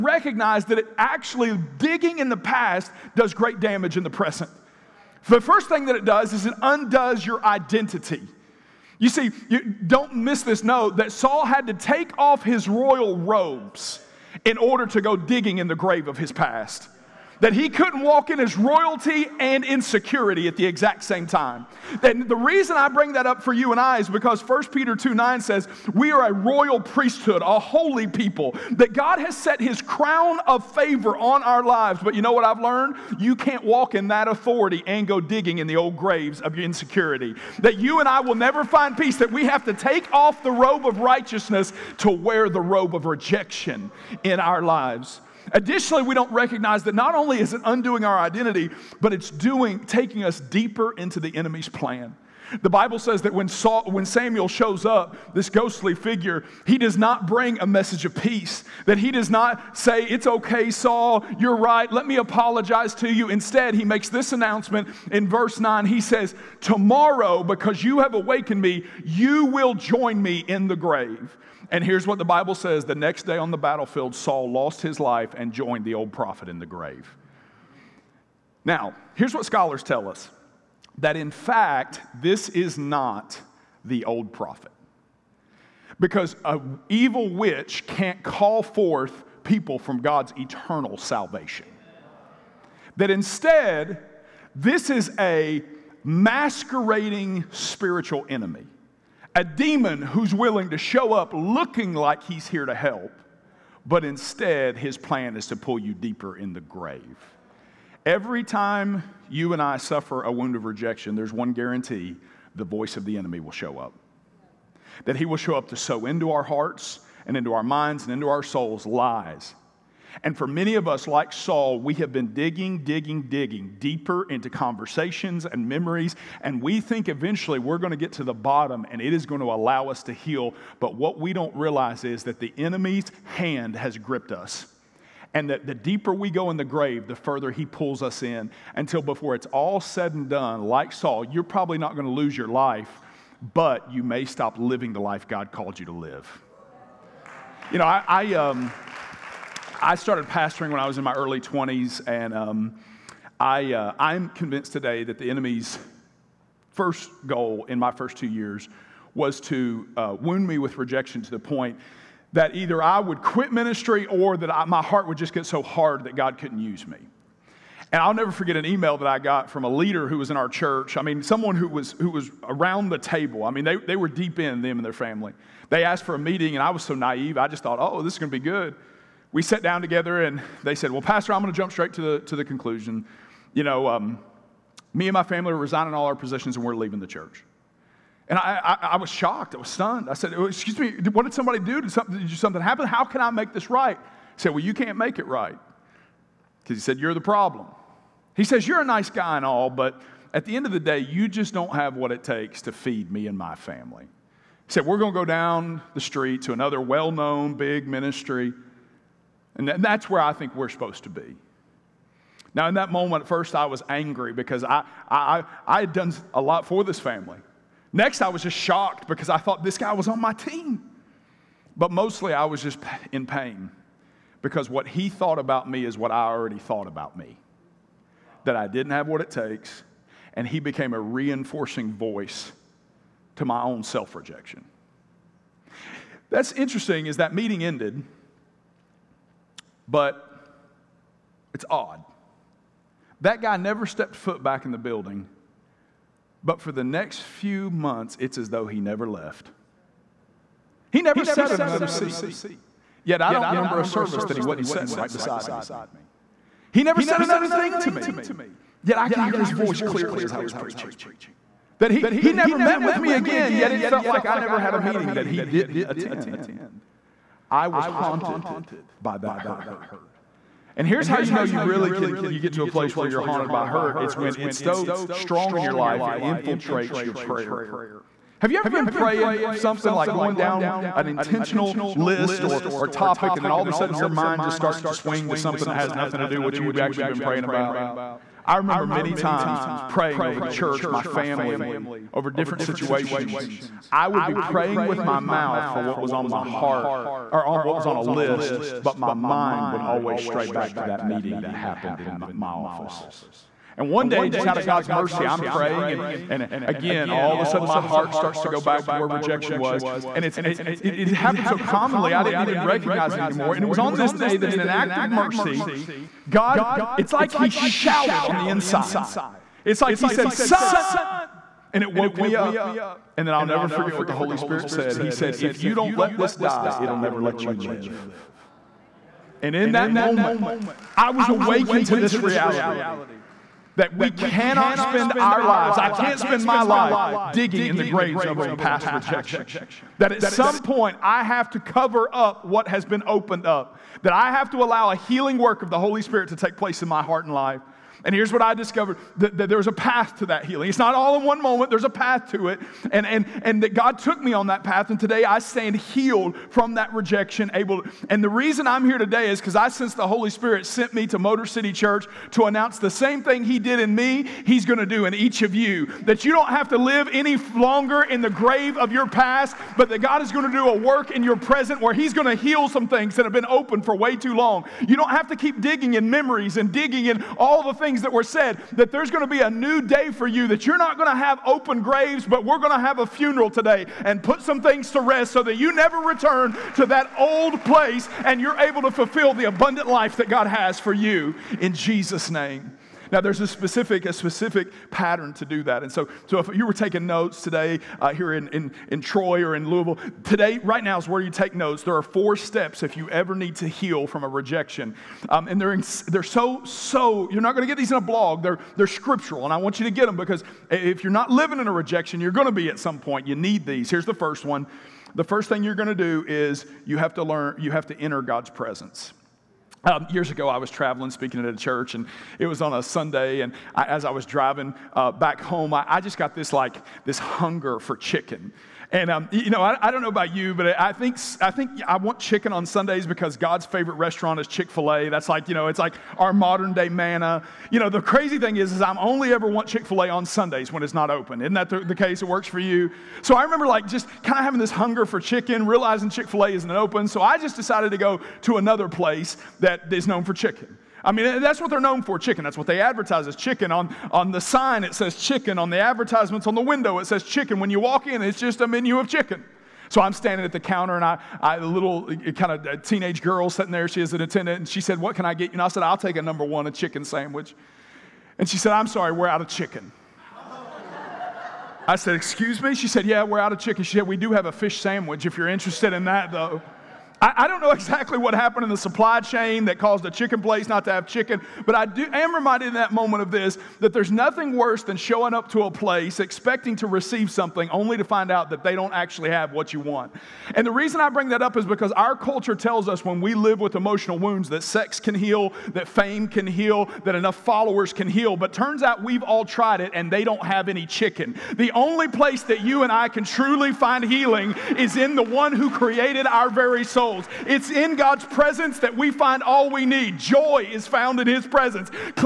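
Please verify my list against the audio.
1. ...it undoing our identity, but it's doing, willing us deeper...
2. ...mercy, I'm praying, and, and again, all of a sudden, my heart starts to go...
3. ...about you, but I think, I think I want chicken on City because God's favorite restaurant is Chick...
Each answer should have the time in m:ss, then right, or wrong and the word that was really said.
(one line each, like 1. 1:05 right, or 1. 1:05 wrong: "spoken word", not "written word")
1. 0:47 wrong: "taking", not "willing"
2. 5:04 right
3. 7:10 wrong: "Sundays", not "City".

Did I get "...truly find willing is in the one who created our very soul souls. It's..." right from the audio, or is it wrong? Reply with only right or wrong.
wrong.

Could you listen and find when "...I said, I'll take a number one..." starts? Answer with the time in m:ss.
7:45.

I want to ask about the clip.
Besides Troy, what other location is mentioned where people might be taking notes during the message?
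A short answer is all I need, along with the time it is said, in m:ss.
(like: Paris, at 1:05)
Louisville, at 6:39.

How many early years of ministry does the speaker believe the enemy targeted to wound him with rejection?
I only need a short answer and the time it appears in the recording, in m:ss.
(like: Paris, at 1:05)
2, at 2:37.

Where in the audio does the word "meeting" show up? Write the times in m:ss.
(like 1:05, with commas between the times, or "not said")
2:56, 3:57, 4:24, 5:01.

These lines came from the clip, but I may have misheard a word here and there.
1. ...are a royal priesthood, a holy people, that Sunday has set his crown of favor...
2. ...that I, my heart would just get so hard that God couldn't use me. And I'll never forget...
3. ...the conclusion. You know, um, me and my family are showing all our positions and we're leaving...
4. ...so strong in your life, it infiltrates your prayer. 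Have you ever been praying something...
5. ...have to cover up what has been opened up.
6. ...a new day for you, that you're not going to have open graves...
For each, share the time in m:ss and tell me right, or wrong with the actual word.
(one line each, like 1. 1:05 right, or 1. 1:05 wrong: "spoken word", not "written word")
1. 0:26 wrong: "God", not "Sunday"
2. 2:44 right
3. 3:02 wrong: "resigning", not "showing"
4. 4:34 right
5. 5:41 right
6. 6:19 right.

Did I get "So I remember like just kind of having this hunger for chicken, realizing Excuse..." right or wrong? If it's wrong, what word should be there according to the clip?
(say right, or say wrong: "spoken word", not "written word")
wrong: "Chick", not "Excuse".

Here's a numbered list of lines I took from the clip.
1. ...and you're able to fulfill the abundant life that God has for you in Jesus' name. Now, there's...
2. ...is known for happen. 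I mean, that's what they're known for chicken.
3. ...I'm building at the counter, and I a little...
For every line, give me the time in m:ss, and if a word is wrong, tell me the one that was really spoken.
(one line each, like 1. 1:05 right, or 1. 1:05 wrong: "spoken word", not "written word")
1. 6:28 right
2. 7:29 wrong: "chicken", not "happen"
3. 7:40 wrong: "standing", not "building".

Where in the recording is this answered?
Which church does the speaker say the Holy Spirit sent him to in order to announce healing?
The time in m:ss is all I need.
6:01.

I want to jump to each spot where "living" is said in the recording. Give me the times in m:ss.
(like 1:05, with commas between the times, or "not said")
2:24, 6:51.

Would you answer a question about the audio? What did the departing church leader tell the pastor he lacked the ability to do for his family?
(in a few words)
feed.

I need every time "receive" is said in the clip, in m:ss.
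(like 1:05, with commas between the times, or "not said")
8:06.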